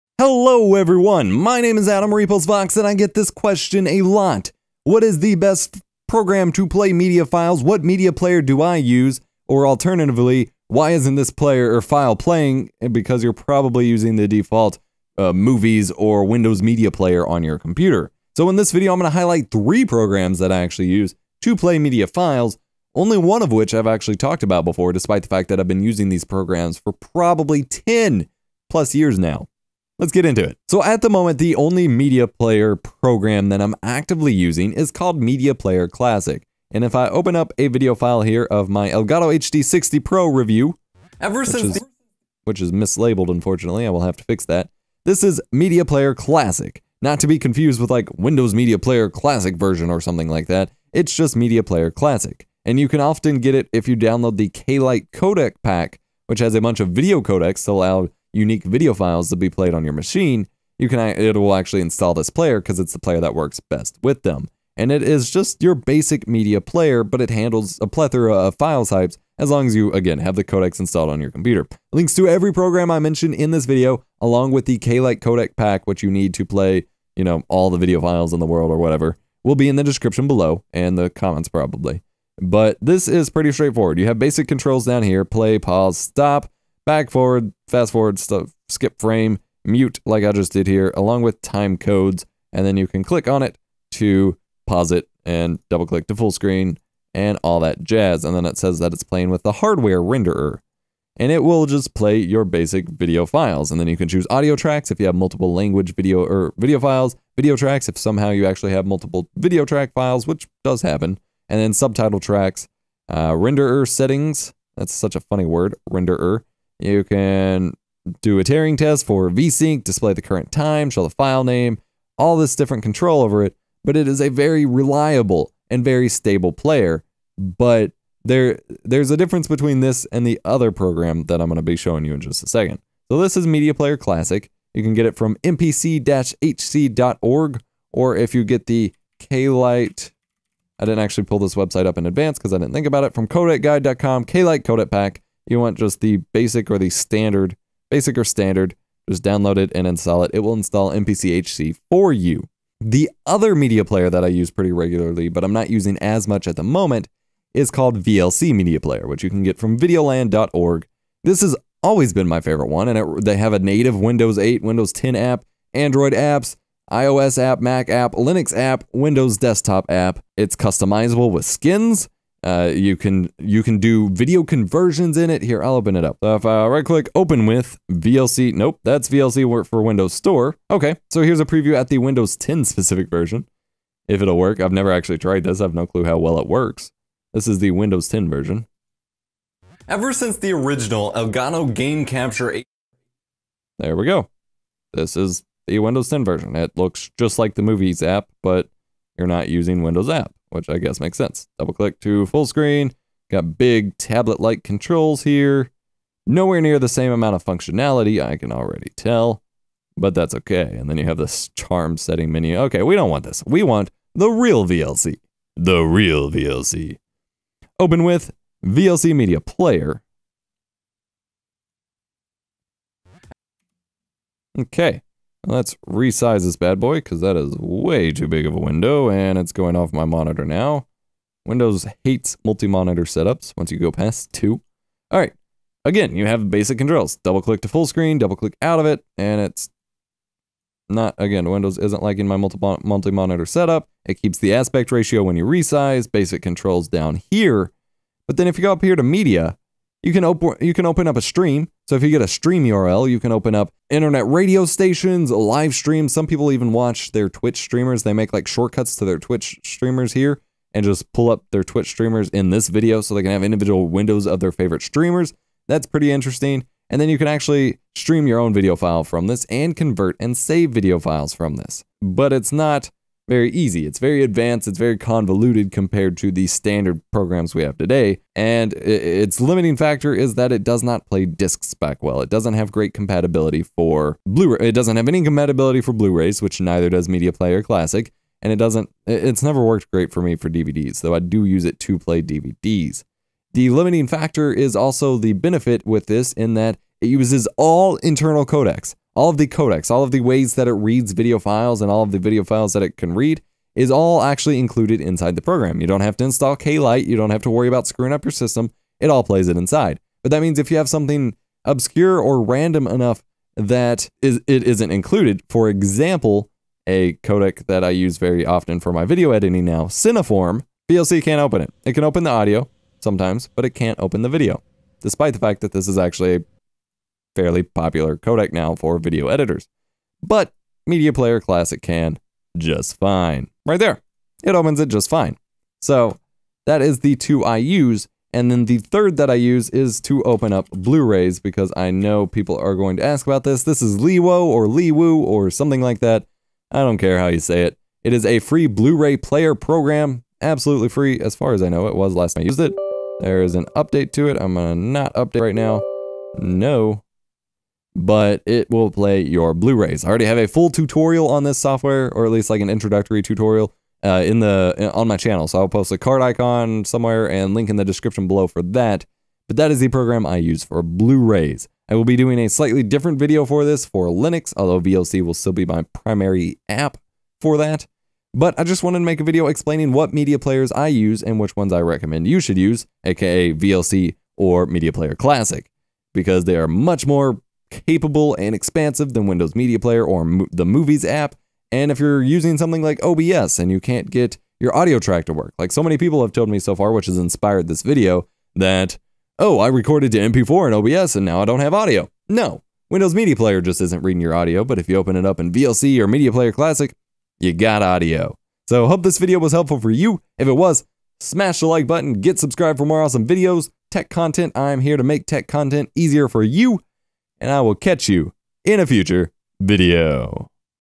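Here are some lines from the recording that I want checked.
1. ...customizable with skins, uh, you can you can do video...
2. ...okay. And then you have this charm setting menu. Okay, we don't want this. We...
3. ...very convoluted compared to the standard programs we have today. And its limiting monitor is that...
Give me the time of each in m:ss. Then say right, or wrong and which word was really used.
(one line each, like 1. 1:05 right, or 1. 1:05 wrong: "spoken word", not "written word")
1. 2:50 right
2. 3:30 right
3. 4:34 wrong: "factor", not "monitor".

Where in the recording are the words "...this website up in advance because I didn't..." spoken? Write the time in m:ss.
2:21.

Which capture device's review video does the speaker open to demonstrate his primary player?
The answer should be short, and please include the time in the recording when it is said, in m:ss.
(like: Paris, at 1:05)
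Elgato HD60 Pro, at 0:38.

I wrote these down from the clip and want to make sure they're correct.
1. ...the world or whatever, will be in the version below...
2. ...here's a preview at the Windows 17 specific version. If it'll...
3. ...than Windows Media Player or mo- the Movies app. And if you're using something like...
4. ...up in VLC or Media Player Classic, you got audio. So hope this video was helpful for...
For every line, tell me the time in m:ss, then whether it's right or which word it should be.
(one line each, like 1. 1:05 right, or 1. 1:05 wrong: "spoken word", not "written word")
1. 1:18 wrong: "description", not "version"
2. 3:01 wrong: "10", not "17"
3. 6:29 right
4. 6:45 right.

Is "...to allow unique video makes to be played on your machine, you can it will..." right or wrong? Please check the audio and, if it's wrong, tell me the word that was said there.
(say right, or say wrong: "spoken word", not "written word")
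wrong: "files", not "makes".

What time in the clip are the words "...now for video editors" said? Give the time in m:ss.
5:28.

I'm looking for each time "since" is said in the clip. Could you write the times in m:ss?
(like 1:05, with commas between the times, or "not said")
0:41, 3:10.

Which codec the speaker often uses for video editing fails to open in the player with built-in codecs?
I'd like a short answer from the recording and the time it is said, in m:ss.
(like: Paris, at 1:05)
Cineform, at 5:19.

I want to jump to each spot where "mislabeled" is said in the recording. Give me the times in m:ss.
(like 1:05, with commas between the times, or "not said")
0:42.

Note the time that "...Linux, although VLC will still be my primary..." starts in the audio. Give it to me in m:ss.
6:14.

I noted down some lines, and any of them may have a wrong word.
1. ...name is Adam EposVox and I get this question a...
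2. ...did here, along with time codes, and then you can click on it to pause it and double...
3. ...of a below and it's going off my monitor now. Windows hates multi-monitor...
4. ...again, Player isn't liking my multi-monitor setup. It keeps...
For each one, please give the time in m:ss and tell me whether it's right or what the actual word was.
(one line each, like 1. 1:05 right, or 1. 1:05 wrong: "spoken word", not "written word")
1. 0:01 right
2. 1:30 right
3. 3:48 wrong: "window", not "below"
4. 4:01 wrong: "Windows", not "Player".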